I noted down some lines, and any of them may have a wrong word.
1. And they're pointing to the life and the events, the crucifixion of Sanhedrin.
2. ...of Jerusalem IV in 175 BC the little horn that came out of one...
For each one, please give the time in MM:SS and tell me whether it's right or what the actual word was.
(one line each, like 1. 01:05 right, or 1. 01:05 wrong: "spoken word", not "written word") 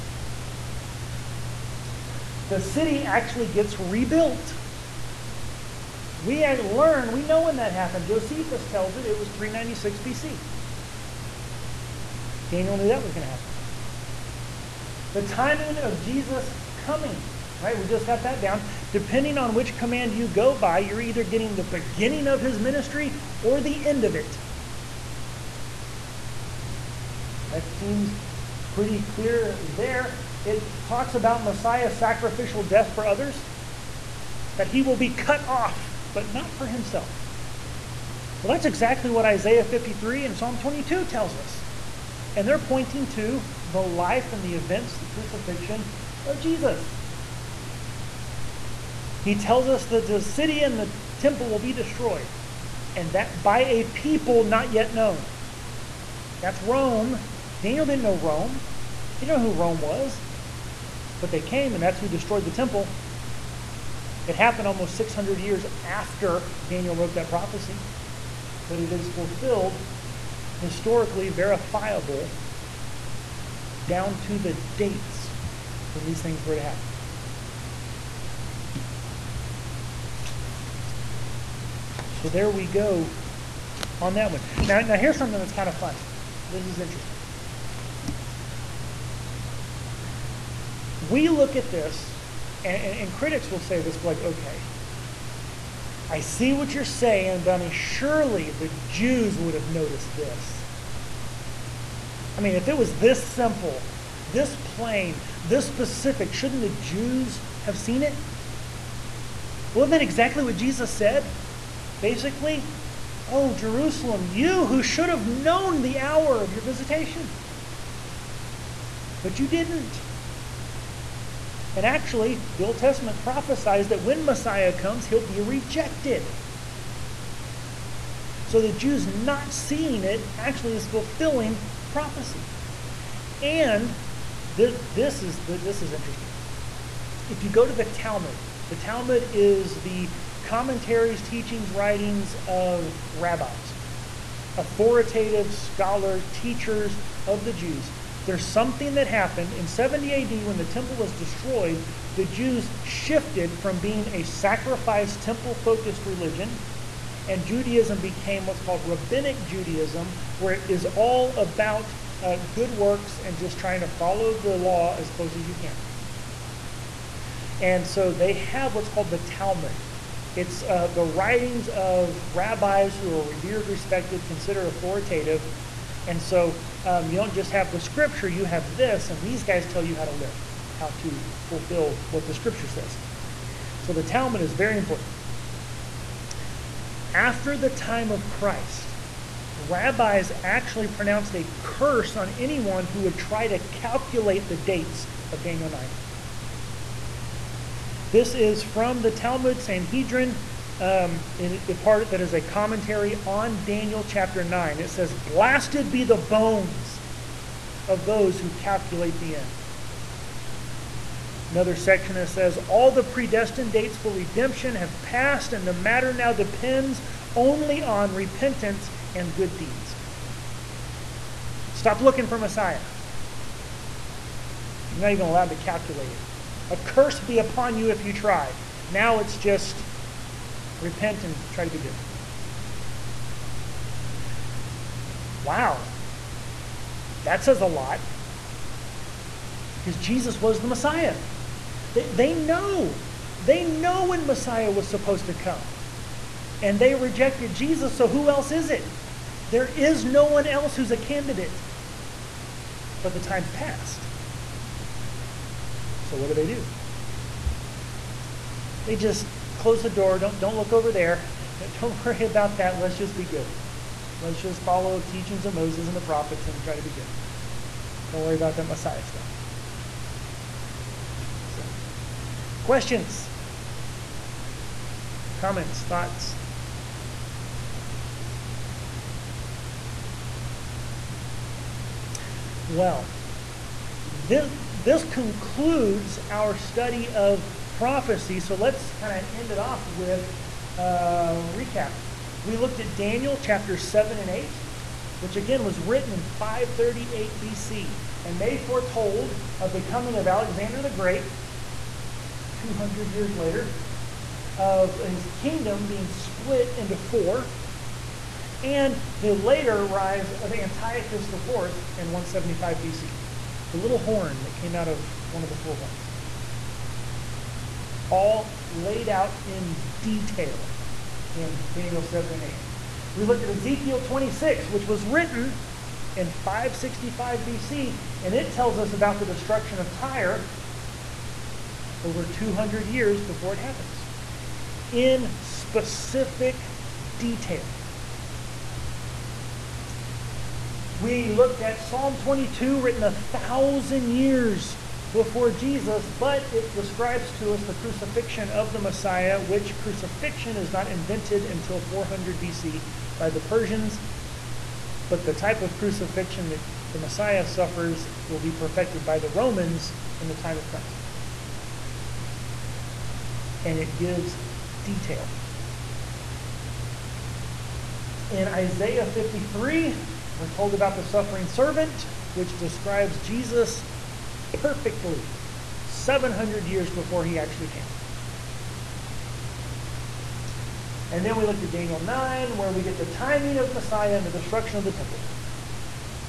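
1. 00:42 wrong: "Jesus", not "Sanhedrin"
2. 05:10 wrong: "Antiochus", not "Jerusalem".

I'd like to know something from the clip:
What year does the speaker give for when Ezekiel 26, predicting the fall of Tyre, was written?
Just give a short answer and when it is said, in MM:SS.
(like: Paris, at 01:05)
565 BC, at 05:26.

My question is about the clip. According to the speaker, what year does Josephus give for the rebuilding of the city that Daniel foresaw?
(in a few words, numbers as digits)
396 BC.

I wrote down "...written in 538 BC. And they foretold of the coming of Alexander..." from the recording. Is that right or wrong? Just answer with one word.
right.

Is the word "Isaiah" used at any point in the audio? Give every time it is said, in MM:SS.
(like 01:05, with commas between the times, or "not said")
00:39, 06:08.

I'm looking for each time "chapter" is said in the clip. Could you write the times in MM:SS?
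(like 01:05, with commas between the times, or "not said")
03:24, 04:53.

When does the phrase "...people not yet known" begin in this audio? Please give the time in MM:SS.
00:53.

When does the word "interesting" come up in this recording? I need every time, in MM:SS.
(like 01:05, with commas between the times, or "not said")
01:26, 02:15.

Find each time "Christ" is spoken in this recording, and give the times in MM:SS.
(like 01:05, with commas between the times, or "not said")
03:08, 06:00.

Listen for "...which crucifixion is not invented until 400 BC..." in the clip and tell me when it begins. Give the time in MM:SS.
05:49.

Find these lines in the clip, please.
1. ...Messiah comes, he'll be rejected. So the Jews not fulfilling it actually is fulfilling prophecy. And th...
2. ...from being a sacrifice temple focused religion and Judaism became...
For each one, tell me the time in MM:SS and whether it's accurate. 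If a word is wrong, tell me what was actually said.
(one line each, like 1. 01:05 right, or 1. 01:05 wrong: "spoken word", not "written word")
1. 02:04 wrong: "seeing", not "fulfilling"
2. 02:33 right.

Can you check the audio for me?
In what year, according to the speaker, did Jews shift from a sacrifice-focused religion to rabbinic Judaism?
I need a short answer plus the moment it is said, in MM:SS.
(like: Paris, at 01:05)
70 AD, at 02:29.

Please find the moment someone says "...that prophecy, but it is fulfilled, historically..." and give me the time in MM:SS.
01:07.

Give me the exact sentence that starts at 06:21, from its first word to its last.
And then we looked at Daniel 9, where we get the timing of Messiah and the destruction of the temple.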